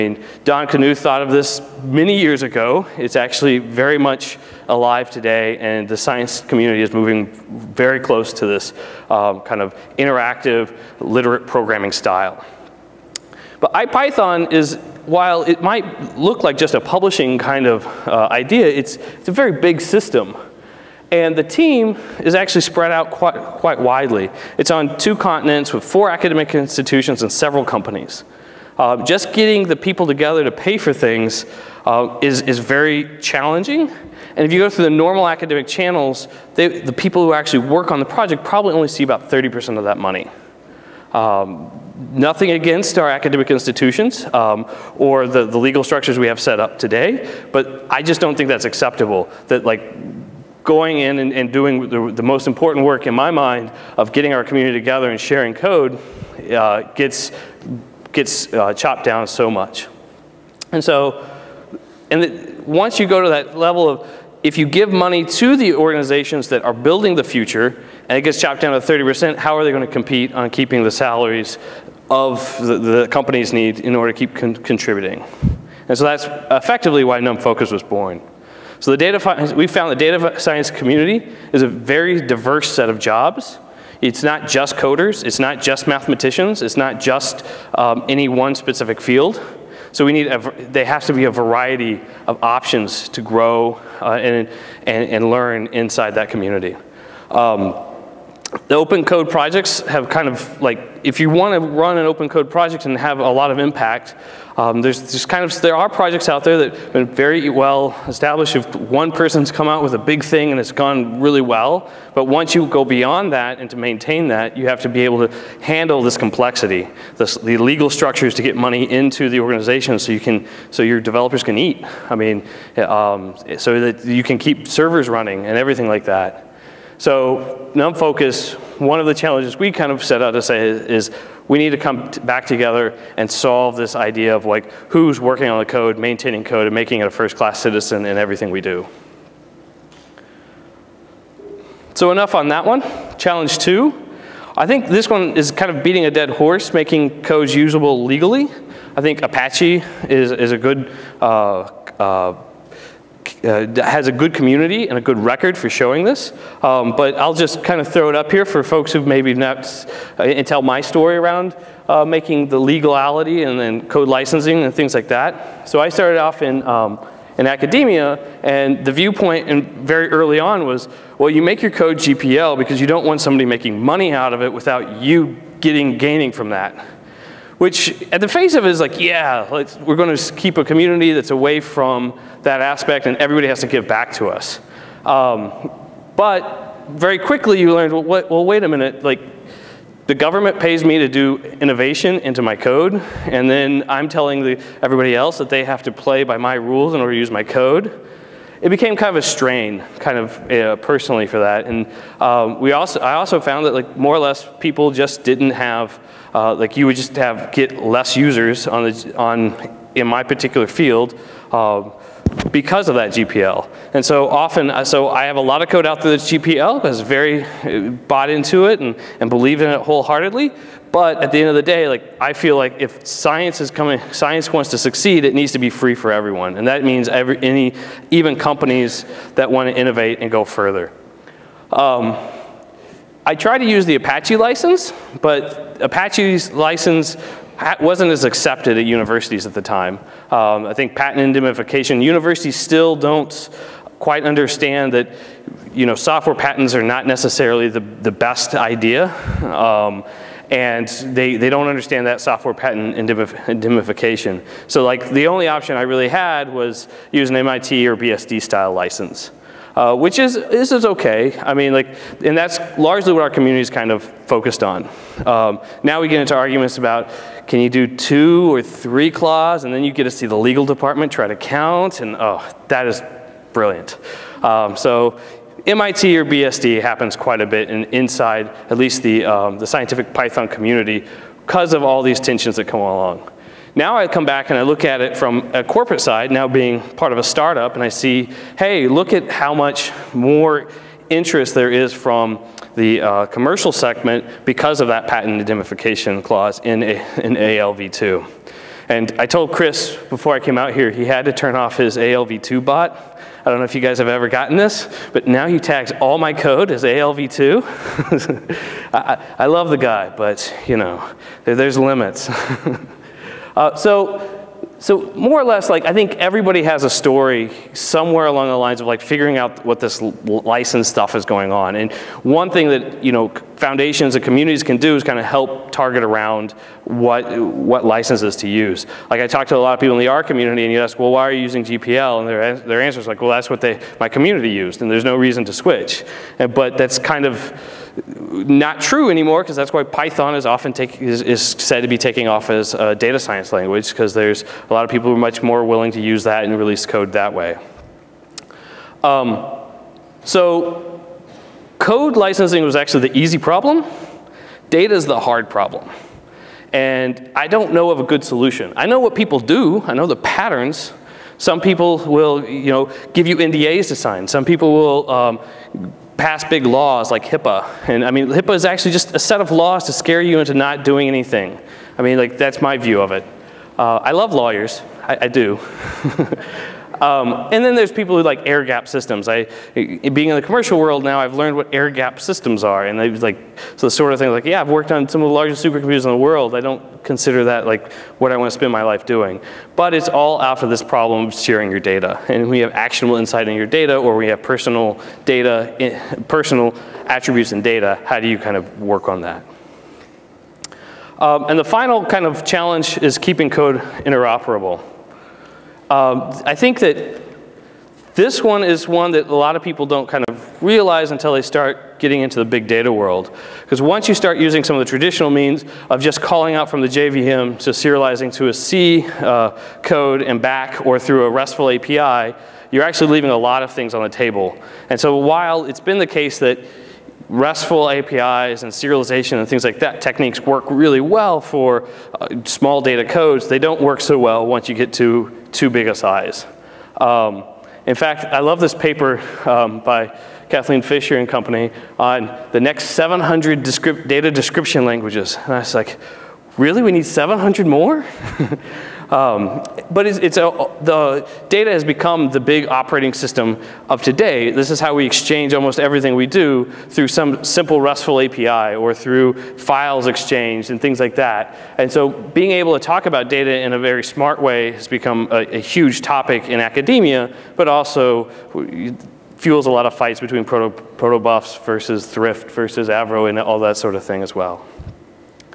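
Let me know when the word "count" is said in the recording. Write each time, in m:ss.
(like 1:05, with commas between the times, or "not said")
4:31.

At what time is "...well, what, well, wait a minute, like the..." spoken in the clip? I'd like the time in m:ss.
3:07.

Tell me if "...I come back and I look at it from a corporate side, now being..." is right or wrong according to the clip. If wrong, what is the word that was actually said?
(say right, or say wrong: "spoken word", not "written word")
right.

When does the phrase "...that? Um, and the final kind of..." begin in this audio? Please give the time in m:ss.
6:39.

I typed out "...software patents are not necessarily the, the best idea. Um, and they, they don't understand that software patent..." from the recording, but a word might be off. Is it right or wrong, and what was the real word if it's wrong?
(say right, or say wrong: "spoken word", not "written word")
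right.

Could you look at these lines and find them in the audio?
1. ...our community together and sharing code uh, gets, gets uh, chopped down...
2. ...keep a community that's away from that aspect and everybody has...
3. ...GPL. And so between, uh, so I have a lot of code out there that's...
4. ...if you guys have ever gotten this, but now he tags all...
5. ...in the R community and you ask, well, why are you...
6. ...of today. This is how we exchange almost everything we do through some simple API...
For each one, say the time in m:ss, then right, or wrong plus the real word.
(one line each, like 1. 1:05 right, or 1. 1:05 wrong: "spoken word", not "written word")
1. 0:54 right
2. 3:00 right
3. 3:33 wrong: "often", not "between"
4. 5:03 right
5. 5:29 right
6. 7:33 wrong: "RESTful", not "API".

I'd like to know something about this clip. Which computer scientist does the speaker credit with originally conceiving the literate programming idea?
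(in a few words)
Don Knuth.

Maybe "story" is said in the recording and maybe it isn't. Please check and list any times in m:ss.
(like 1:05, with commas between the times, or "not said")
2:40, 5:16.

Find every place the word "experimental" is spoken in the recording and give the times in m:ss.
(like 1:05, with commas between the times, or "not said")
not said.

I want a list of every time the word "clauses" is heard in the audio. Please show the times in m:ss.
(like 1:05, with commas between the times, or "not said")
4:29, 4:56.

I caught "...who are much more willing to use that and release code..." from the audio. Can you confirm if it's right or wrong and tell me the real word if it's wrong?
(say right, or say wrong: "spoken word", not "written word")
right.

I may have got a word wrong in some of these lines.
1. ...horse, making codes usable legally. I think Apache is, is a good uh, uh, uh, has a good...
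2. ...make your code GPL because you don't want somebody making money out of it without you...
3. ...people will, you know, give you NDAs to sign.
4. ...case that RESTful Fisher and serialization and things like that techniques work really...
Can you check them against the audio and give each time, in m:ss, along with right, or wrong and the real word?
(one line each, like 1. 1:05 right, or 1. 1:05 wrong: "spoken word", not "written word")
1. 2:26 right
2. 2:51 right
3. 6:01 right
4. 7:06 wrong: "APIs", not "Fisher".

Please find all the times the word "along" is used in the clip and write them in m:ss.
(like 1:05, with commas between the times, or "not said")
4:42, 5:18.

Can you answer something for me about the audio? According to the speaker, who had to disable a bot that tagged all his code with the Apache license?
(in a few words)
Chris.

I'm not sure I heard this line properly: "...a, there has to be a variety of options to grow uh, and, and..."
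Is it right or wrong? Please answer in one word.
right.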